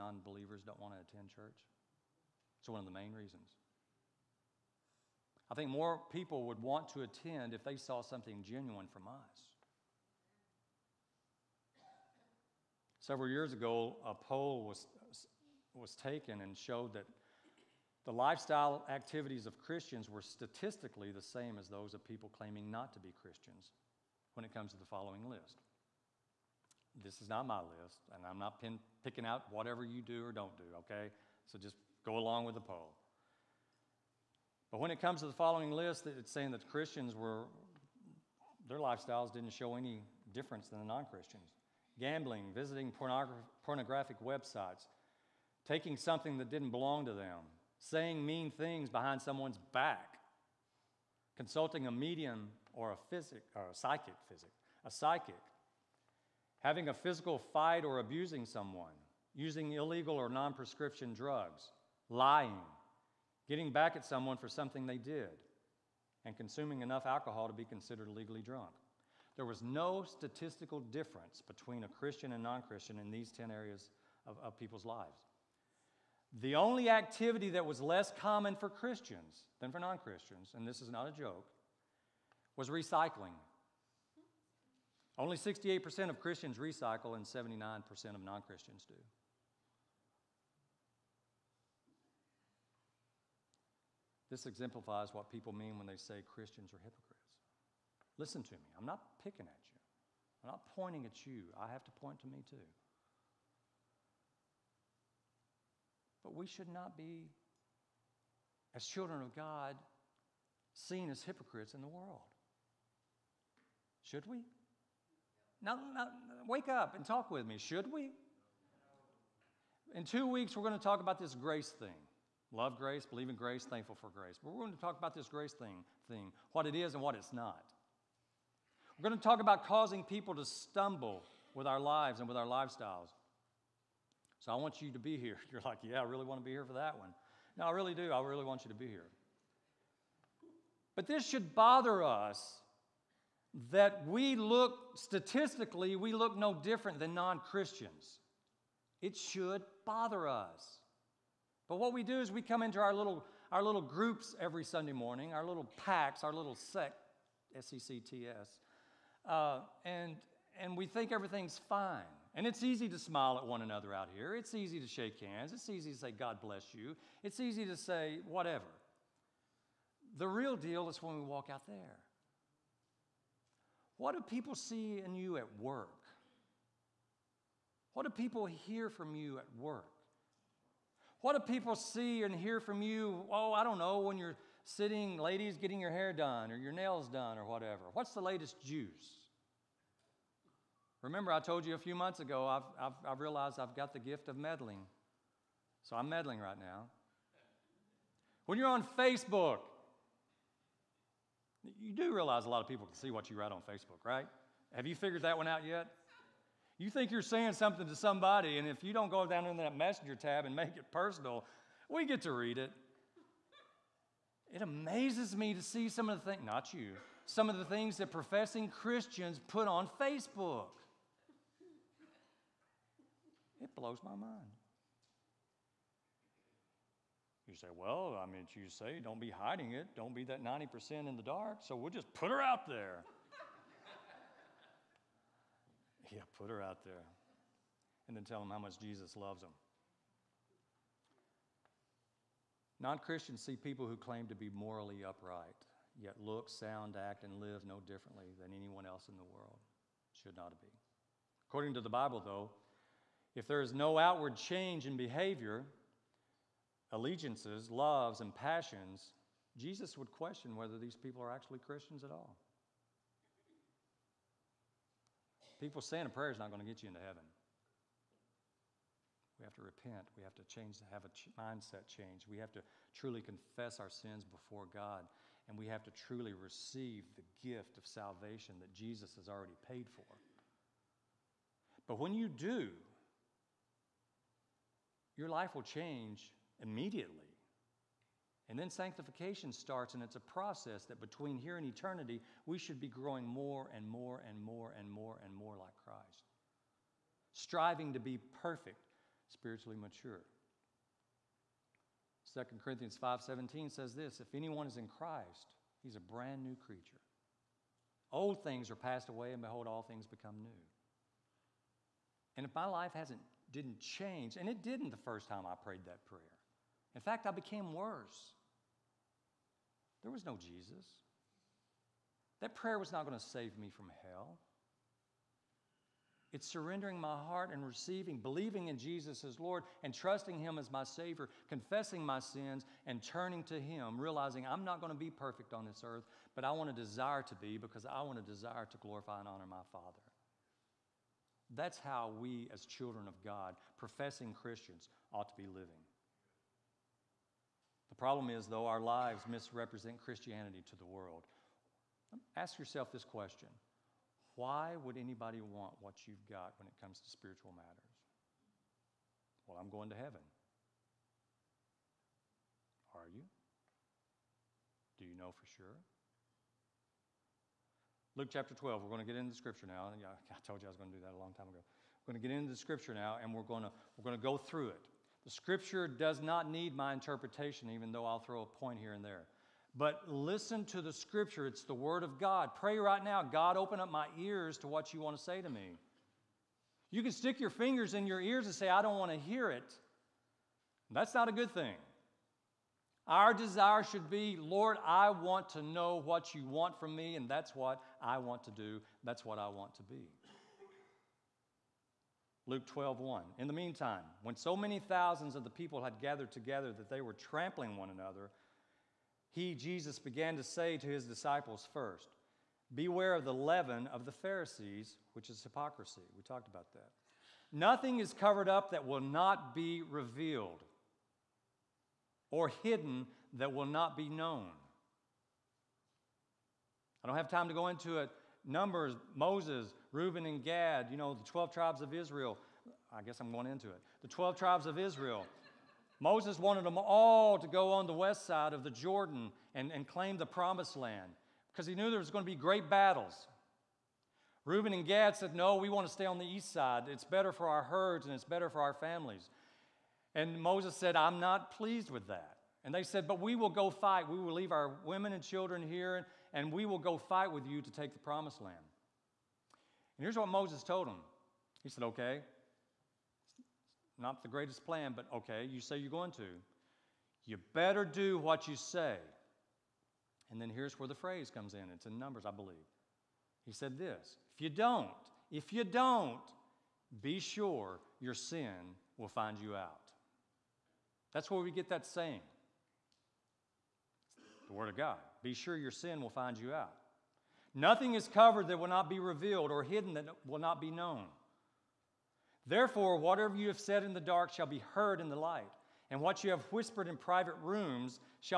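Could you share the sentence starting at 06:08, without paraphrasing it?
Luke chapter 12, we're going to get into the scripture now.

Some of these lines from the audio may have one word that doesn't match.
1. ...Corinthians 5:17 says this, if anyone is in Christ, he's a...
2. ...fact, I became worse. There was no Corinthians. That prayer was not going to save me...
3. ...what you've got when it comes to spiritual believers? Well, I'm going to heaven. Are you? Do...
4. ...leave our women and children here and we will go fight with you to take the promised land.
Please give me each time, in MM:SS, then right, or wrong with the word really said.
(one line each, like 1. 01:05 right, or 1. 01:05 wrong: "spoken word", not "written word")
1. 05:02 right
2. 05:17 wrong: "Jesus", not "Corinthians"
3. 05:55 wrong: "matters", not "believers"
4. 07:34 right.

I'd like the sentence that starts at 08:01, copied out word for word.
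That's where we get that saying.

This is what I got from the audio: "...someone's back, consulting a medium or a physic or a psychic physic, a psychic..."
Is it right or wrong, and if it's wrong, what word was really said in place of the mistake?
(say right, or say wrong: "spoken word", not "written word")
right.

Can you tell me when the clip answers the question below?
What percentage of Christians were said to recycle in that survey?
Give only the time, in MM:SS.
01:25.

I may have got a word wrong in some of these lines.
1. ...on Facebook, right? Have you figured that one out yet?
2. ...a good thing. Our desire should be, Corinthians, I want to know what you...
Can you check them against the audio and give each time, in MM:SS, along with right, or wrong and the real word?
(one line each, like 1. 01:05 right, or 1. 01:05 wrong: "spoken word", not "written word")
1. 03:23 right
2. 06:31 wrong: "Lord", not "Corinthians".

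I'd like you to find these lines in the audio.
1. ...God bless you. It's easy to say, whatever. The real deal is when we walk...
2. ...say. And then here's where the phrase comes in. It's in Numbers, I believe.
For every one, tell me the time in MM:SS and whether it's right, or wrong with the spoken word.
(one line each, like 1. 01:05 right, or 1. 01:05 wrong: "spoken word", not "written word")
1. 02:46 right
2. 07:48 right.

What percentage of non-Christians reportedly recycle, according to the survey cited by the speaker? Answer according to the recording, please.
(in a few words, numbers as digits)
79%.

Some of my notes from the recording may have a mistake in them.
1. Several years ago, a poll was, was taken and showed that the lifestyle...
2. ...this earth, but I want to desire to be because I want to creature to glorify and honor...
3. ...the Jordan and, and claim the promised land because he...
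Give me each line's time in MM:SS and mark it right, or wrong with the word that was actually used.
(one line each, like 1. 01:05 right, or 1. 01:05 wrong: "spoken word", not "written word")
1. 00:12 right
2. 05:35 wrong: "desire", not "creature"
3. 07:18 right.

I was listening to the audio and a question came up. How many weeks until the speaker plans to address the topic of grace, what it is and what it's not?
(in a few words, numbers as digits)
2.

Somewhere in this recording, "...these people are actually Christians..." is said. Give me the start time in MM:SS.
04:20.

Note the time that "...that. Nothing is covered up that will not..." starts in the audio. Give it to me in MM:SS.
06:56.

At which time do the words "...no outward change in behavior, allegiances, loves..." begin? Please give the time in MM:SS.
04:13.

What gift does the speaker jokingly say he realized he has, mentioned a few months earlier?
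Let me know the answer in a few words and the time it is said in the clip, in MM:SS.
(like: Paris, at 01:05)
the gift of meddling, at 03:13.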